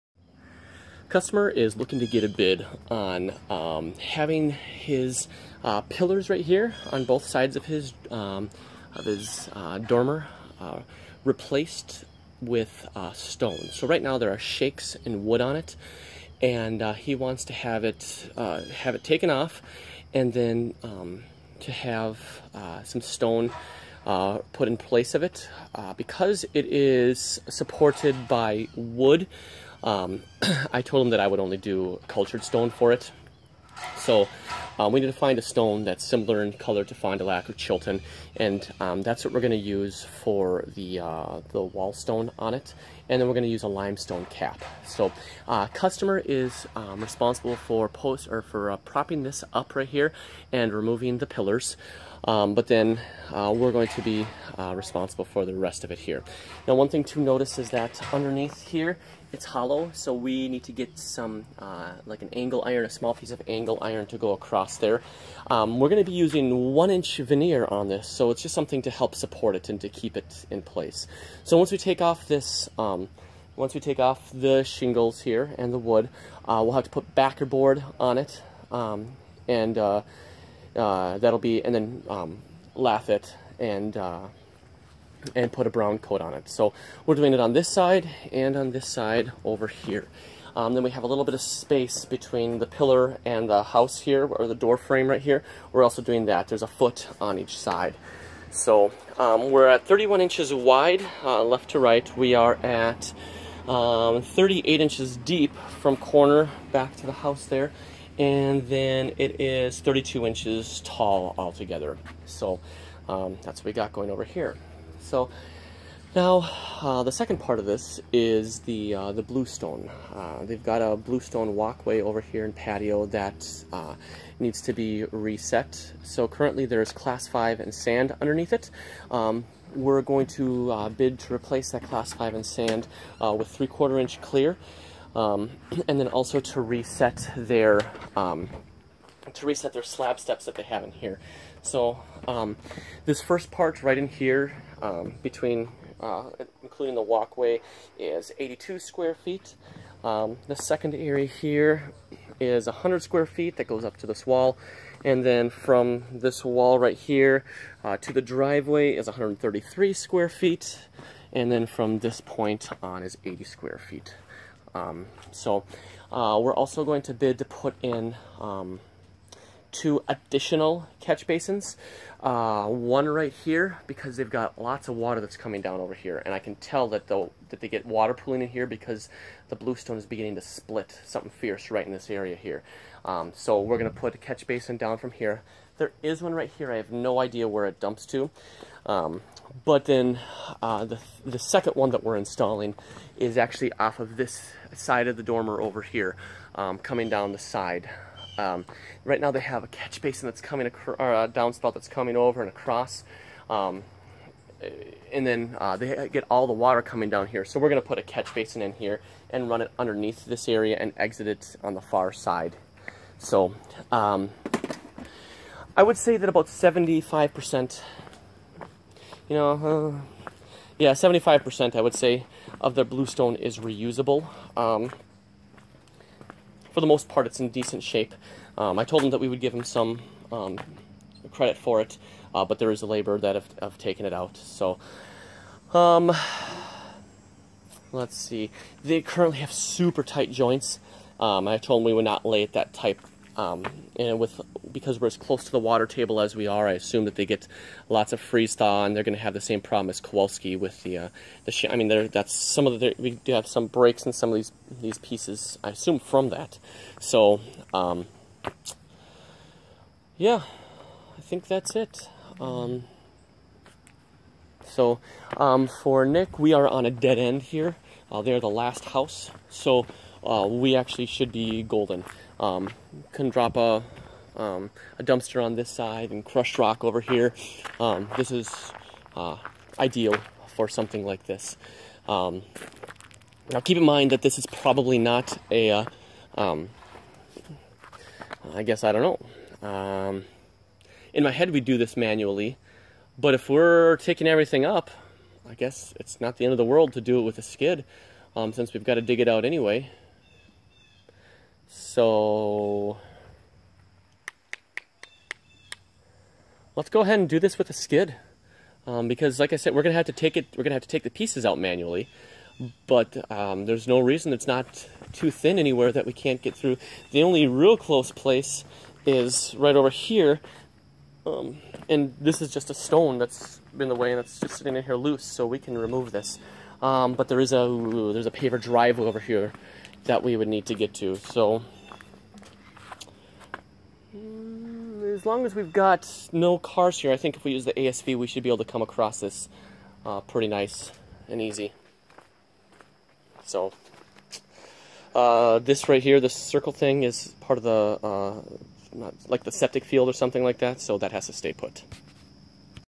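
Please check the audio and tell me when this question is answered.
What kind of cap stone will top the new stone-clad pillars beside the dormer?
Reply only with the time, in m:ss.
0:43.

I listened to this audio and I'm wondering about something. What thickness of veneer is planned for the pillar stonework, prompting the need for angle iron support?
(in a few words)
1 inch.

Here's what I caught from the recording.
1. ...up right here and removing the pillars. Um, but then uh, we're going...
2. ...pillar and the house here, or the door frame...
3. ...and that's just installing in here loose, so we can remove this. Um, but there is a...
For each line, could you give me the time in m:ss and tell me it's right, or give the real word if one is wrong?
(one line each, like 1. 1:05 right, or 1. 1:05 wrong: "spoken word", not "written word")
1. 0:49 right
2. 1:32 right
3. 5:24 wrong: "sitting", not "installing".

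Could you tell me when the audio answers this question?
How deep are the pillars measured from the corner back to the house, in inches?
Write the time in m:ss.
1:44.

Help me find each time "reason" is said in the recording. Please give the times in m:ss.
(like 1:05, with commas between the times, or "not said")
5:13.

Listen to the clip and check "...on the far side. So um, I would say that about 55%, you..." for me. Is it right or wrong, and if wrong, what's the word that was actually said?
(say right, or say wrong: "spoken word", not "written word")
wrong: "75", not "55".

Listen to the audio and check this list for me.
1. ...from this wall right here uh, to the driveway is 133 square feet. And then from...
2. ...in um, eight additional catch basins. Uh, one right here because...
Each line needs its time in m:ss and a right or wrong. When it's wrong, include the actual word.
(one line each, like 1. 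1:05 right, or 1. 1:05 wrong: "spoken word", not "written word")
1. 2:35 right
2. 2:47 wrong: "two", not "eight".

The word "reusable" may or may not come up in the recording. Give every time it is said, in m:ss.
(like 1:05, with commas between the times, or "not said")
3:43.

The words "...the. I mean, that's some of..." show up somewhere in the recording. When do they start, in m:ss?
4:11.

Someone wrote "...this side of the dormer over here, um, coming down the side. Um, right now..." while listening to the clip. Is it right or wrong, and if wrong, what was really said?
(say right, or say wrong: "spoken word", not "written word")
right.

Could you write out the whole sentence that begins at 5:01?
So let's go ahead and do this with a skid.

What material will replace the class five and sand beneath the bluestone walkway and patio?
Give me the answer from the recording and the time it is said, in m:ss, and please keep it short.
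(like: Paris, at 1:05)
3/4 inch clear, at 2:13.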